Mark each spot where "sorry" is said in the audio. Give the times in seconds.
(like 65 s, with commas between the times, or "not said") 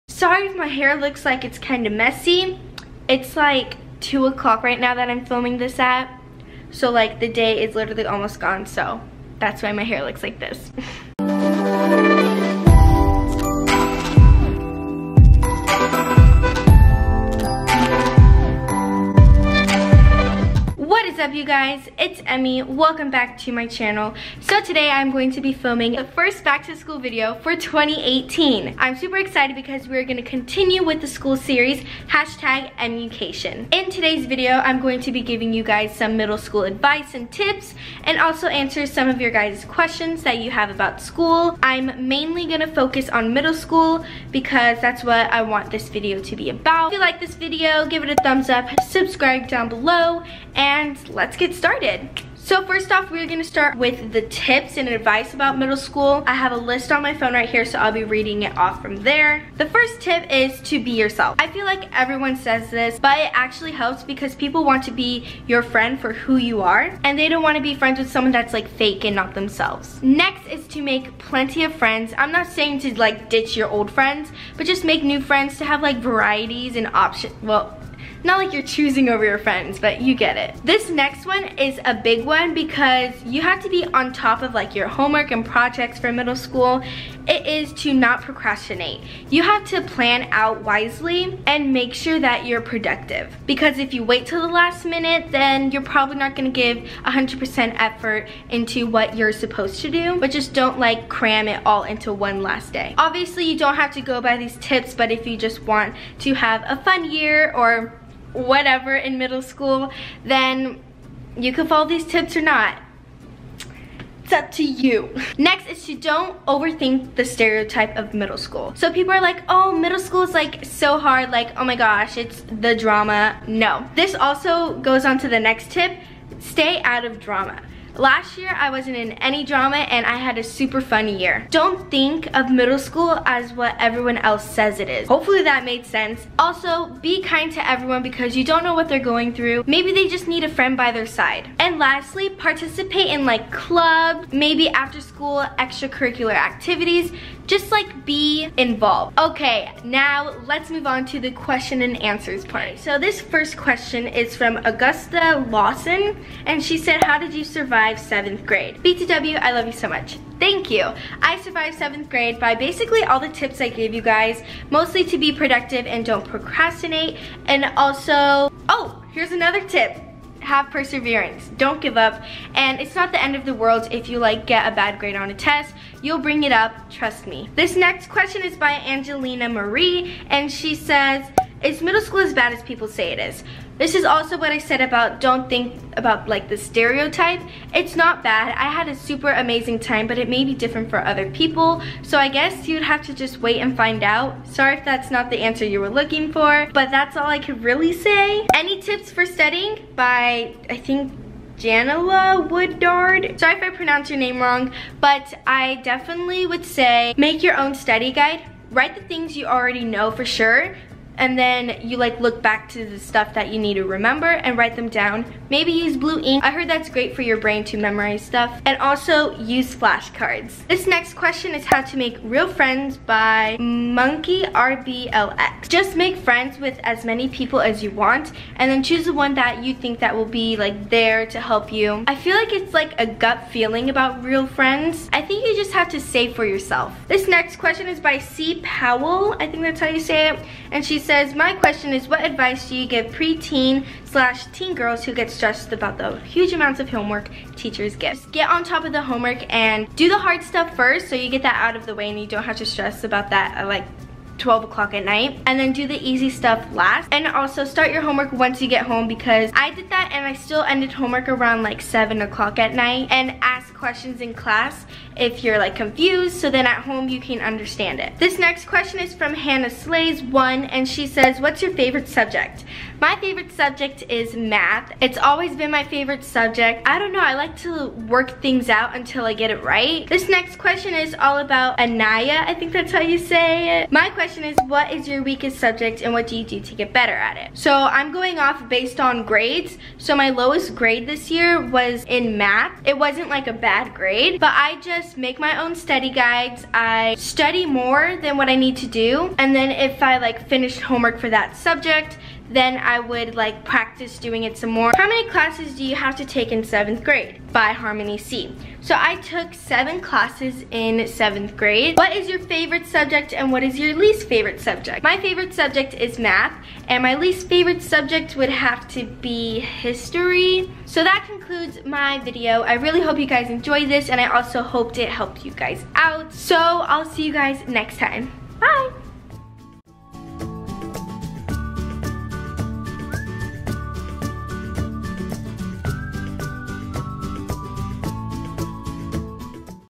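0 s, 194 s, 203 s.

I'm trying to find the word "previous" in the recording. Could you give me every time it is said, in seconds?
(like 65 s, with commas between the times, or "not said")
not said.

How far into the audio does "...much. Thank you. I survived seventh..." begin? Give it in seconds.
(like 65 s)
159 s.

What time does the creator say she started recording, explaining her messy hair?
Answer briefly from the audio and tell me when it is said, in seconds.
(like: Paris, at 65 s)
2 o'clock, at 4 s.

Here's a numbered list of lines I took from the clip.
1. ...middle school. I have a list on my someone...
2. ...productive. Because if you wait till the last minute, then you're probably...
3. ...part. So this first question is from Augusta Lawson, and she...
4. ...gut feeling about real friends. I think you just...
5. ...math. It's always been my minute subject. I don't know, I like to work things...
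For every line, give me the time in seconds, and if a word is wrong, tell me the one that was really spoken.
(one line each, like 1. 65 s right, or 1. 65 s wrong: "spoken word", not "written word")
1. 55 s wrong: "phone", not "someone"
2. 92 s right
3. 152 s right
4. 233 s right
5. 274 s wrong: "favorite", not "minute".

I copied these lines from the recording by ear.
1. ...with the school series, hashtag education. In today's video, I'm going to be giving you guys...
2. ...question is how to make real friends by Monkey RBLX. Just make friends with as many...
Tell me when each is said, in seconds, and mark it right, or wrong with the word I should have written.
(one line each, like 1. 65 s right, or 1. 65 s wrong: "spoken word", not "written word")
1. 30 s right
2. 221 s right.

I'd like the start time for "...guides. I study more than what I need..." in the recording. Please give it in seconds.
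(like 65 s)
296 s.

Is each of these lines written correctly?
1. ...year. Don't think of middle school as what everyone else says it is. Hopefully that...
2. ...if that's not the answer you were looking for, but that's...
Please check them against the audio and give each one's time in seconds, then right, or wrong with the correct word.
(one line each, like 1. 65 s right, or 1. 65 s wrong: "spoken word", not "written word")
1. 131 s right
2. 194 s right.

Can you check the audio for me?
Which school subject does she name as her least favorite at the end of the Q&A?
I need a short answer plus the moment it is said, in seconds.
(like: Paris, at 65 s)
history, at 319 s.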